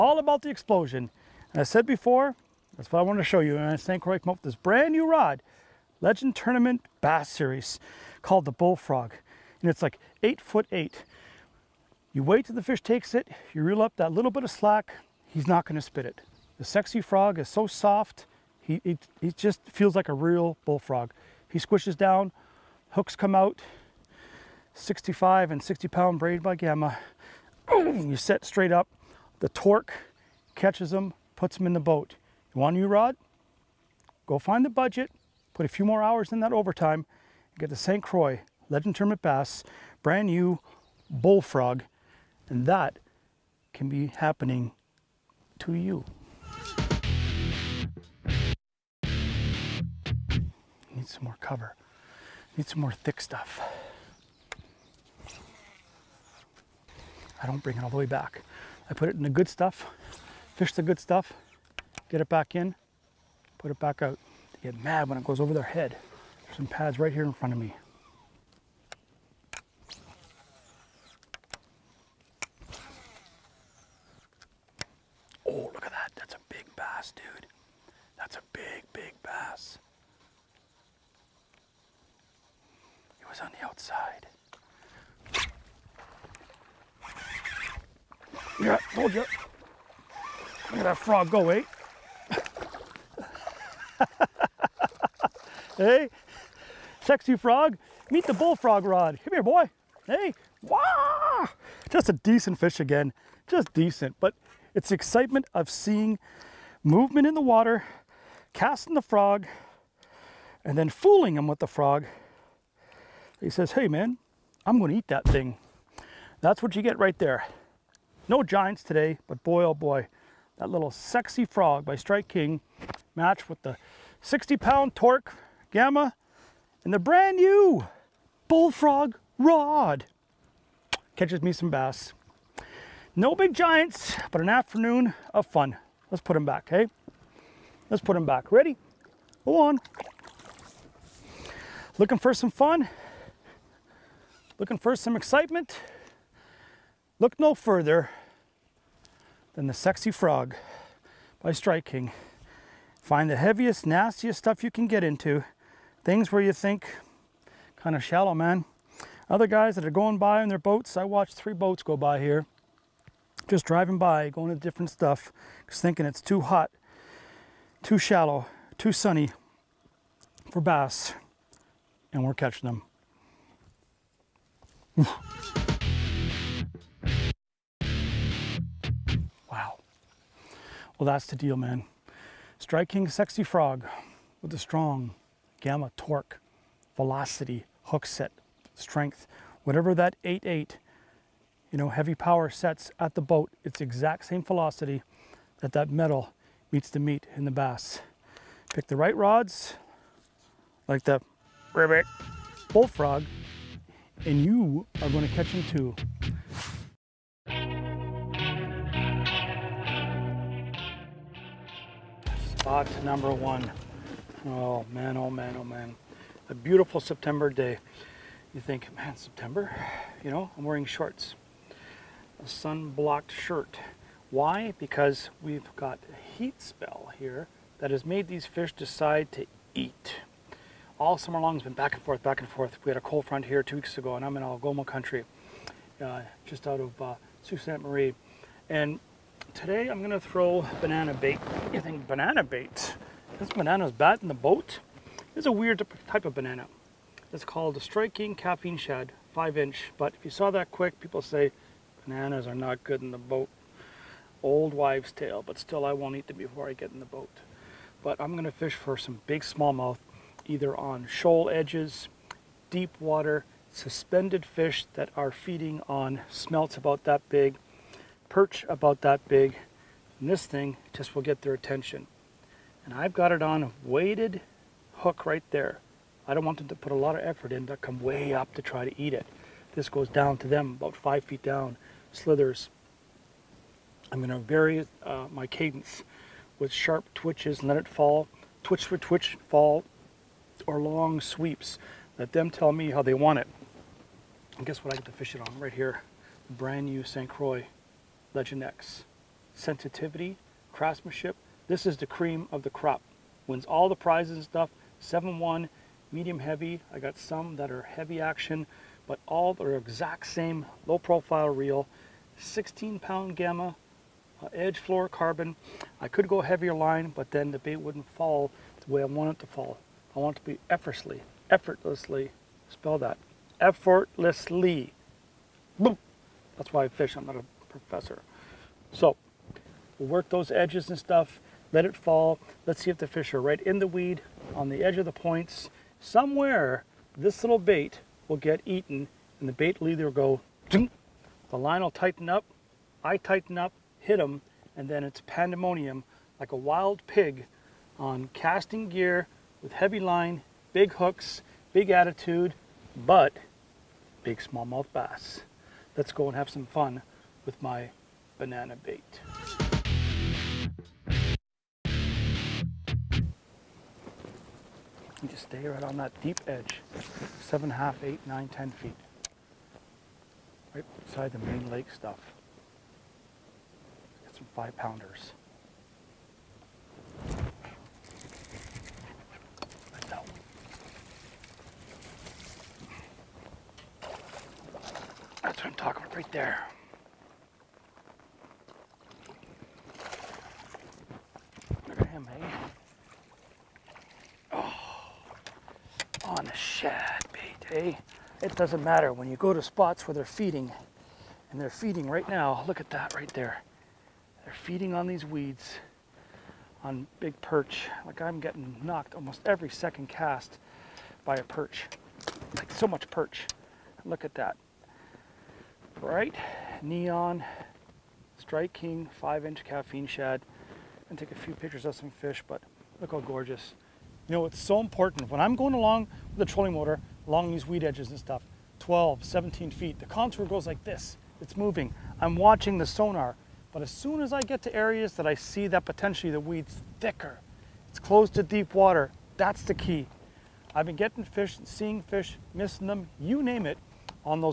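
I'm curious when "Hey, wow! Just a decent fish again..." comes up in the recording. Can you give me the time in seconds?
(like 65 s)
100 s.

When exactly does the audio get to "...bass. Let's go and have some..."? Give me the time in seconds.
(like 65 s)
354 s.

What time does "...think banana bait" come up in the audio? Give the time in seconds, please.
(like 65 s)
241 s.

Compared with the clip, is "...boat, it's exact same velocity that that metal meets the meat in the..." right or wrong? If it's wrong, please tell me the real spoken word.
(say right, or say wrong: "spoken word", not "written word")
right.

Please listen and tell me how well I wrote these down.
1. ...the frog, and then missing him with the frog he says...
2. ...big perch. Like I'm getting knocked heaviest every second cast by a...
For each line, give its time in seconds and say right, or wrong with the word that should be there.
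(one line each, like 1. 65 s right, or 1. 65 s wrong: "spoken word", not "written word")
1. 108 s wrong: "fooling", not "missing"
2. 407 s wrong: "almost", not "heaviest".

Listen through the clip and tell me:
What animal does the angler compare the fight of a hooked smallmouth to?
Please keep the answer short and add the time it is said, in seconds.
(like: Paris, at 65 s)
wild pig, at 346 s.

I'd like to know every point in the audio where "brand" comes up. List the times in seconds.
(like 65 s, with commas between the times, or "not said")
4 s, 40 s, 126 s, 296 s.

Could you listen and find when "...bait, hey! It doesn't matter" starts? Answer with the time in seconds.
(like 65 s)
397 s.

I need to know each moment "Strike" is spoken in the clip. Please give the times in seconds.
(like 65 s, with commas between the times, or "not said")
121 s, 151 s, 182 s, 247 s, 418 s.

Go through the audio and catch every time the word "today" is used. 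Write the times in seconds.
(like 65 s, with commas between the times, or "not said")
118 s, 239 s.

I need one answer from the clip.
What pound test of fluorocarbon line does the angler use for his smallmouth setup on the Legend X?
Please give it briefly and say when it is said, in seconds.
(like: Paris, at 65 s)
16, at 312 s.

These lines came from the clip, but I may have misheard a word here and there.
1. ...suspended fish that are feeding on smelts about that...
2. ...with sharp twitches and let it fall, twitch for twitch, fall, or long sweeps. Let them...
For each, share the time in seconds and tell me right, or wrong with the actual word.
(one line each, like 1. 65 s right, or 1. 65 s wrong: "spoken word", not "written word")
1. 263 s right
2. 286 s right.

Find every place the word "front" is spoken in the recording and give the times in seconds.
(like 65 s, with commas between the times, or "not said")
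67 s, 233 s.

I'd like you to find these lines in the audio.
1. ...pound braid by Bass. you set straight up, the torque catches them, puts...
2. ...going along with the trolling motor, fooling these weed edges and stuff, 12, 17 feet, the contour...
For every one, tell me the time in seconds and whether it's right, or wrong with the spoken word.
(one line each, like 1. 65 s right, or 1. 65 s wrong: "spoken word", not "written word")
1. 25 s wrong: "Gamma", not "Bass"
2. 425 s wrong: "along", not "fooling".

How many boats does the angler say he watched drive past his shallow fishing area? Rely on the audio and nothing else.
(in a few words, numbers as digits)
3.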